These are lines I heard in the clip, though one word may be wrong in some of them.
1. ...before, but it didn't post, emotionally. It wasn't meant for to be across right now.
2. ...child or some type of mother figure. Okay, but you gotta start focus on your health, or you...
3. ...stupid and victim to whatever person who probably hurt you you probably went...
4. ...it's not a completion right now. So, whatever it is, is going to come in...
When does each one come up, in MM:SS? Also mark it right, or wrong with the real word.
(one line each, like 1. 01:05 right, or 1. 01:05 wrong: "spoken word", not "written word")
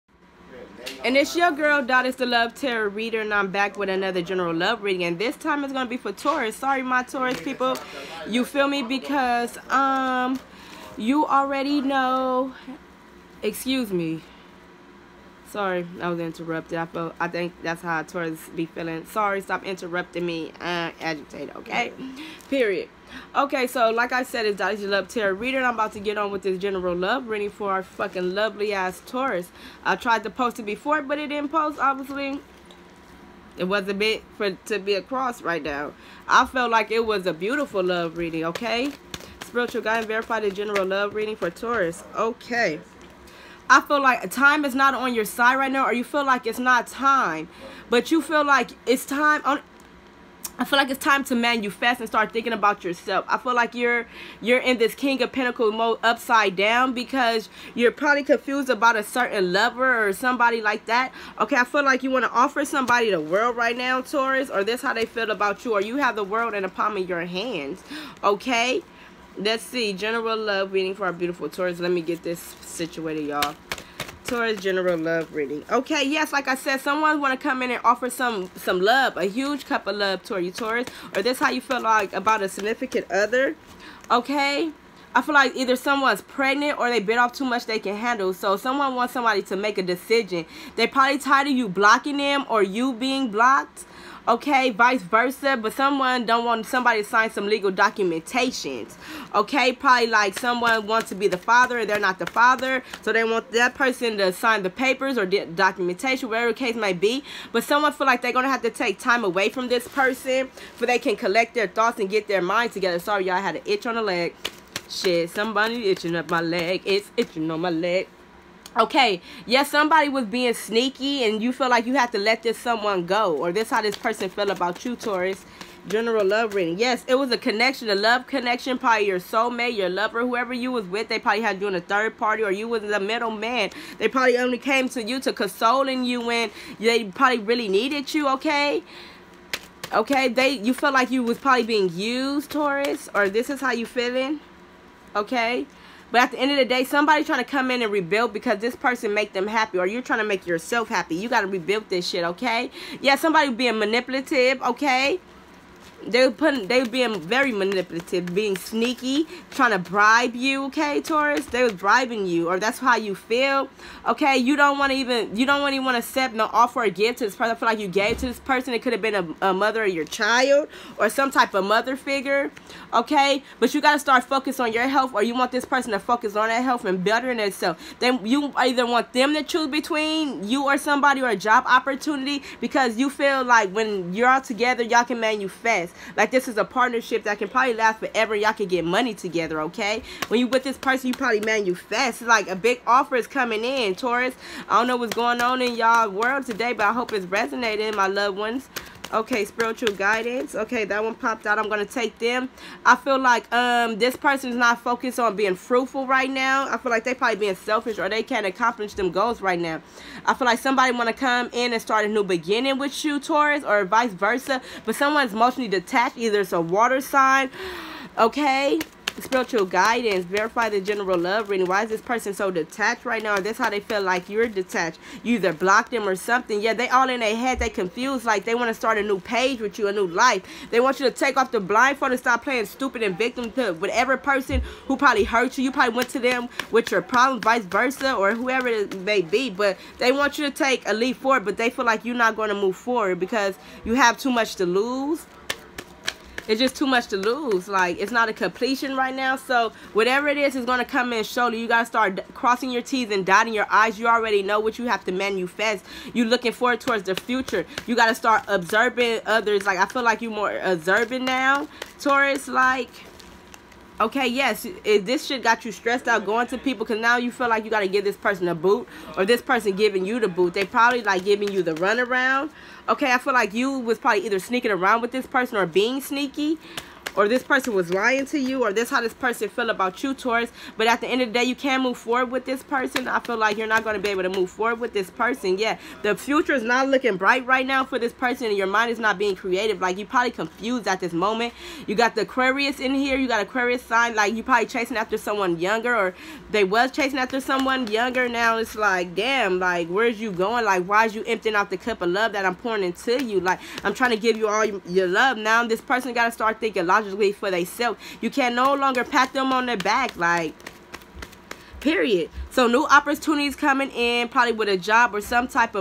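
1. 00:30 wrong: "obviously", not "emotionally"
2. 02:50 right
3. 03:52 right
4. 04:07 right.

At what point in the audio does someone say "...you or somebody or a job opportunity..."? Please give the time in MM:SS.
03:00.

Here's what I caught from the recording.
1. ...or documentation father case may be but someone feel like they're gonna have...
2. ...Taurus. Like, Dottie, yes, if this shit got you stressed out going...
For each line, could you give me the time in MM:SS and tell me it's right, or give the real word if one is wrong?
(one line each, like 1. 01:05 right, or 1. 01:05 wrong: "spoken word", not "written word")
1. 01:45 wrong: "whatever", not "father"
2. 04:21 wrong: "Okay", not "Dottie".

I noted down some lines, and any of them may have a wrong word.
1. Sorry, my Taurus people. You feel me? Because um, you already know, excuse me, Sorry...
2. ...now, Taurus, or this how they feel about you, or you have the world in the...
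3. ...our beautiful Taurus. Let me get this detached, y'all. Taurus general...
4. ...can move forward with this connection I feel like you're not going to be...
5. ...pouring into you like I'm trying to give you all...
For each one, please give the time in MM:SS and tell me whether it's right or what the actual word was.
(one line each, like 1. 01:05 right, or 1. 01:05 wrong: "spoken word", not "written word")
1. 00:06 right
2. 01:03 right
3. 01:11 wrong: "situated", not "detached"
4. 04:41 wrong: "person", not "connection"
5. 05:02 right.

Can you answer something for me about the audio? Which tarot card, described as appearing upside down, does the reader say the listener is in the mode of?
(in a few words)
King of Pentacles.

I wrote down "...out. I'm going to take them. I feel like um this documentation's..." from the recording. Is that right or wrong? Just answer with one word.
wrong.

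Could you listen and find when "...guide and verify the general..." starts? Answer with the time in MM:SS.
00:39.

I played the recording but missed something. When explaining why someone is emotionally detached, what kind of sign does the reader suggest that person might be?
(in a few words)
a water sign.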